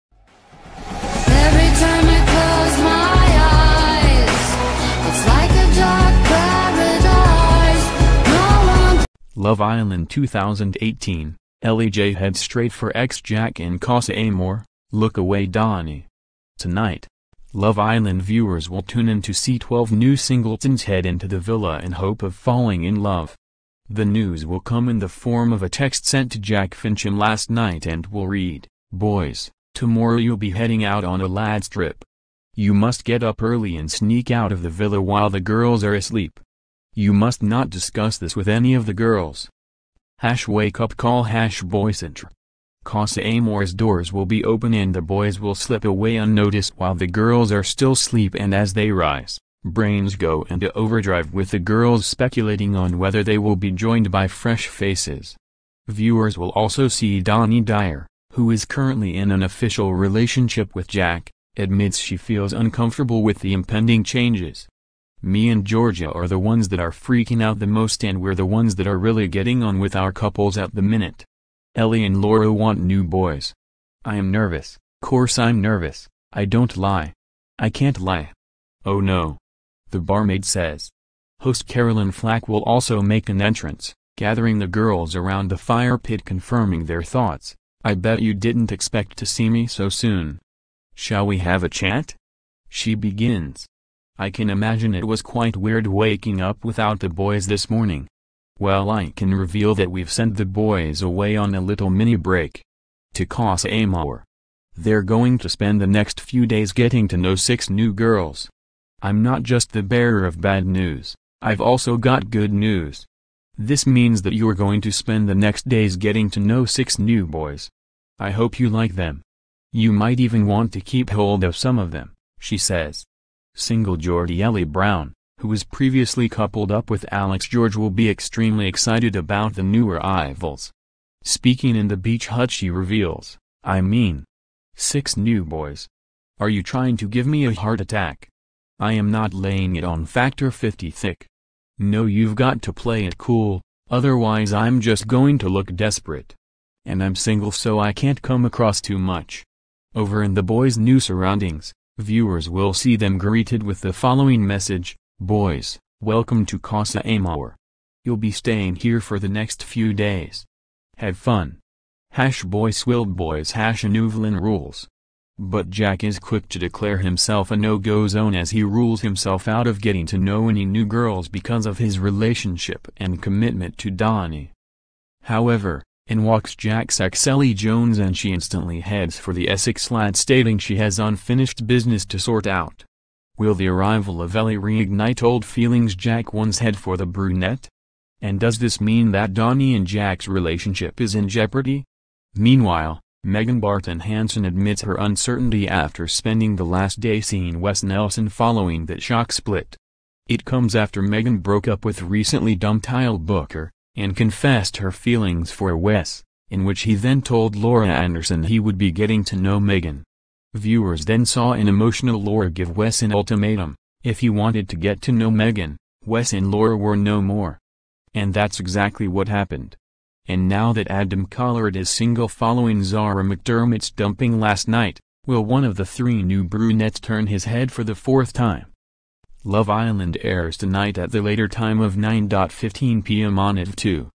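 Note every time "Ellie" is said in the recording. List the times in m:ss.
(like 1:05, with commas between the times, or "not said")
0:11, 1:11, 2:04, 2:57, 3:04.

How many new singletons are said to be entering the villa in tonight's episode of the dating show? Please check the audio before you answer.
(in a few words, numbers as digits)
12.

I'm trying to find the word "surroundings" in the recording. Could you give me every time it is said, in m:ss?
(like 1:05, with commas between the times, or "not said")
2:31.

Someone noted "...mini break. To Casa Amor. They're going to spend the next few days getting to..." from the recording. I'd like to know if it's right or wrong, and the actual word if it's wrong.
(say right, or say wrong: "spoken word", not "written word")
right.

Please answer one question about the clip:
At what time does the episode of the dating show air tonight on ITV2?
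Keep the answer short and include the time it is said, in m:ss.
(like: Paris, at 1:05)
9.15 p.m., at 3:51.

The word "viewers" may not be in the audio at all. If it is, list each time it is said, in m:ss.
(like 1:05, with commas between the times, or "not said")
0:18, 0:55, 2:31, 3:30.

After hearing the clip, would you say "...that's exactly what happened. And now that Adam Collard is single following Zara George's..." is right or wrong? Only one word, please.
wrong.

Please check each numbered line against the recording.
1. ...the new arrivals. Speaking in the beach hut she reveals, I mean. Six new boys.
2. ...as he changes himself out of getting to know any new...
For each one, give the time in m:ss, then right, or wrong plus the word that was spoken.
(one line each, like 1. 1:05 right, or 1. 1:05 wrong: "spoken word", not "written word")
1. 2:09 right
2. 2:48 wrong: "rules", not "changes".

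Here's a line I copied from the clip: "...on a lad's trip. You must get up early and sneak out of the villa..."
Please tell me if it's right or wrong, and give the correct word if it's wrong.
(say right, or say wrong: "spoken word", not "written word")
right.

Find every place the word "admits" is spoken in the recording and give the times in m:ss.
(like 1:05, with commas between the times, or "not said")
1:01, 3:14.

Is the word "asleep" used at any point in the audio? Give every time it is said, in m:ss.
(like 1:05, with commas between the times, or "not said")
0:35, 0:47.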